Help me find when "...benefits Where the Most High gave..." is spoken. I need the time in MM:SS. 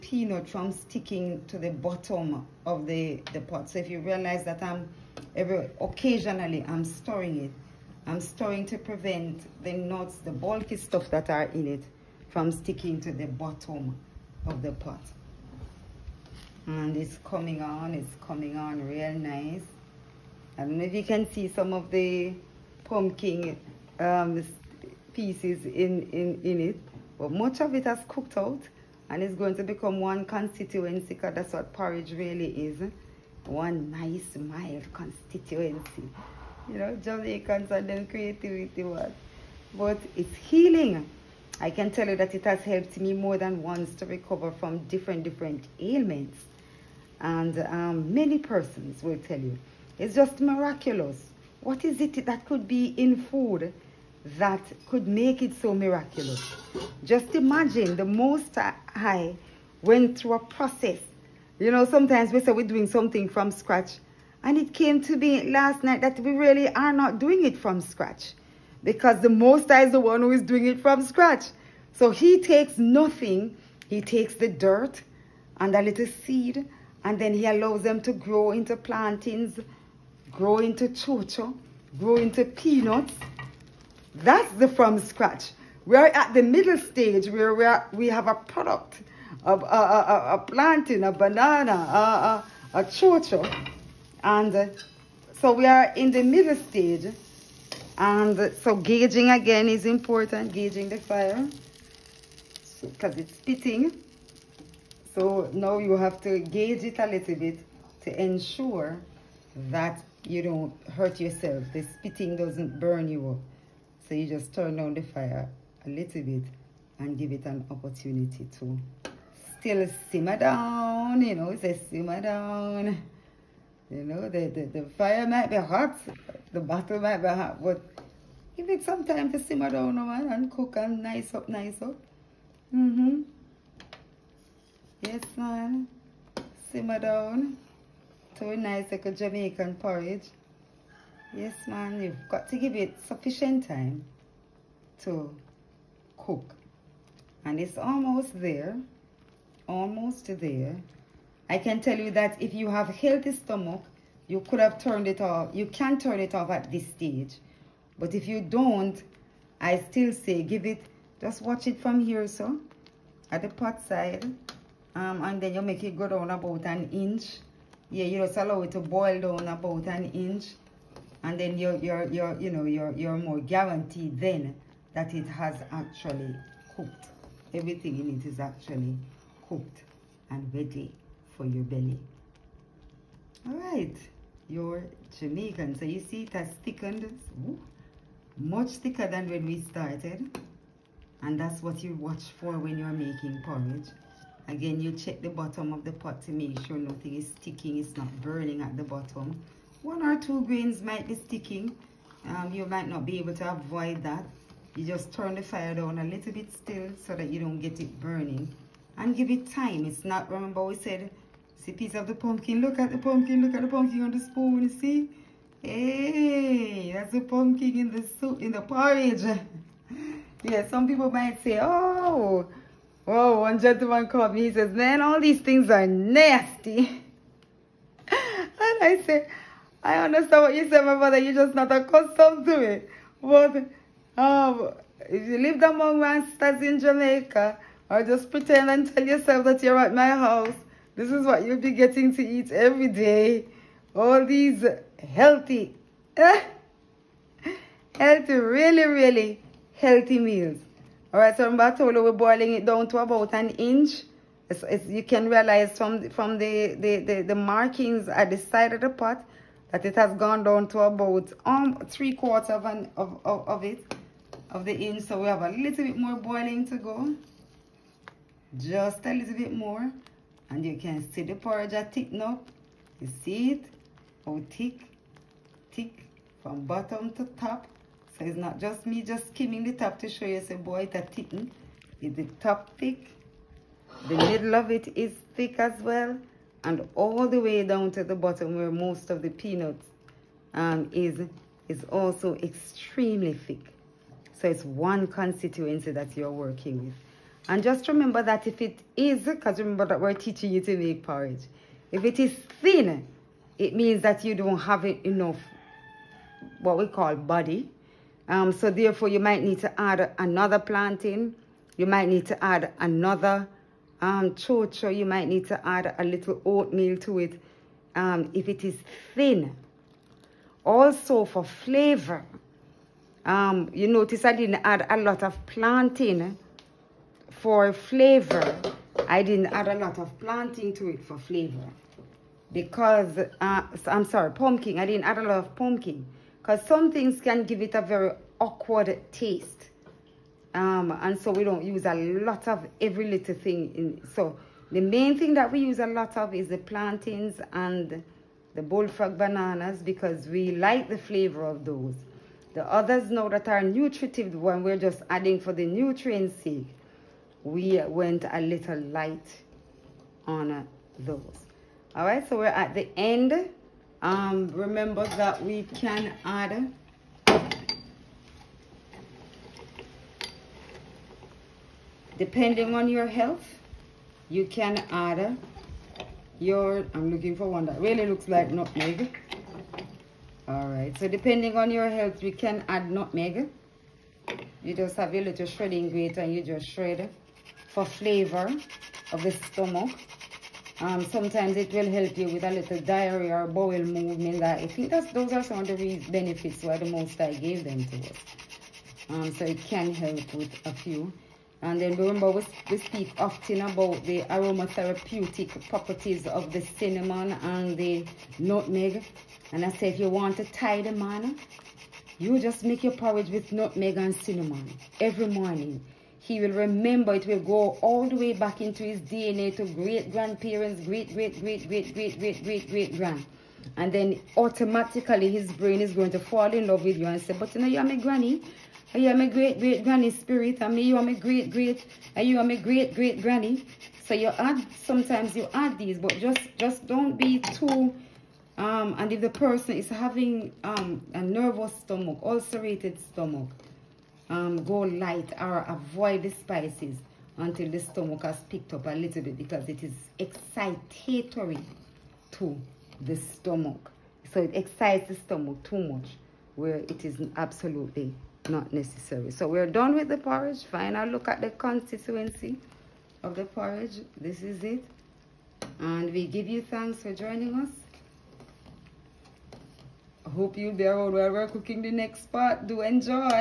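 06:36.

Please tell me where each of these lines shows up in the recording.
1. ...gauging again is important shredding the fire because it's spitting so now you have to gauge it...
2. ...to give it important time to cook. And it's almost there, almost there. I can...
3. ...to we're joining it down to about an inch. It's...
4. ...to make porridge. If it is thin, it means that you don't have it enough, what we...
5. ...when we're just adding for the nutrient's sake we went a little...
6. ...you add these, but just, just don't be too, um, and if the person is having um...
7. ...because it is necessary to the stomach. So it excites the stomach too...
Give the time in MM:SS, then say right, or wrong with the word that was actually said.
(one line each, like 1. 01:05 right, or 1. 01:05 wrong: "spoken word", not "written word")
1. 01:38 wrong: "gauging", not "shredding"
2. 02:22 wrong: "sufficient", not "important"
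3. 04:11 wrong: "boiling", not "joining"
4. 05:00 right
5. 05:54 right
6. 07:15 right
7. 07:29 wrong: "excitatory", not "necessary".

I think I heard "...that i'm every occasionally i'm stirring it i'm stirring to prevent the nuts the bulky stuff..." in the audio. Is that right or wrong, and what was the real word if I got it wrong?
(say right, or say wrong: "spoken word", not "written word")
right.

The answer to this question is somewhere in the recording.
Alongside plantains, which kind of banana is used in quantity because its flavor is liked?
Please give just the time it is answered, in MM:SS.
05:48.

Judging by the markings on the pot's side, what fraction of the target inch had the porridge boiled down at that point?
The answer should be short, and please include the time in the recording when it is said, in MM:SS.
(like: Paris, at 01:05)
Three quarters, at 04:21.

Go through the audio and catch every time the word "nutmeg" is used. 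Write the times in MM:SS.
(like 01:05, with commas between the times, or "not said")
06:18, 06:22, 06:48, 06:53.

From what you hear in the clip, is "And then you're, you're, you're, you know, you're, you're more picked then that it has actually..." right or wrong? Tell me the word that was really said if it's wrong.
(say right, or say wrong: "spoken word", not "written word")
wrong: "guaranteed", not "picked".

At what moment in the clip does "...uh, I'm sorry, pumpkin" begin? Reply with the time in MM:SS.
05:33.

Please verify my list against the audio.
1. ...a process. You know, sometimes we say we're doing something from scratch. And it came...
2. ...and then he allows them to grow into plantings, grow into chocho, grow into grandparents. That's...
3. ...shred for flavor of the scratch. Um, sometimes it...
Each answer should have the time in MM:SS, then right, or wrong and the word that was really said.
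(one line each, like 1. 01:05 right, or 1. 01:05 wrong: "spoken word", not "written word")
1. 01:00 right
2. 01:17 wrong: "peanuts", not "grandparents"
3. 06:26 wrong: "stomach", not "scratch".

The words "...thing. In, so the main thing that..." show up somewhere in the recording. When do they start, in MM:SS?
05:43.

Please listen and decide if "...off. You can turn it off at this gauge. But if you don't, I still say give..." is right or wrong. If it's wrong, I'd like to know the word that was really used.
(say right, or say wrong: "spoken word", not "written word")
wrong: "stage", not "gauge".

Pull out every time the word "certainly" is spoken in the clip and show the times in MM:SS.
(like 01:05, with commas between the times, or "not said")
not said.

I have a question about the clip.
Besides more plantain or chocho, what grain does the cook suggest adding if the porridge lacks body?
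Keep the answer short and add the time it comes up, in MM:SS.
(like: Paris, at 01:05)
Oatmeal, at 05:15.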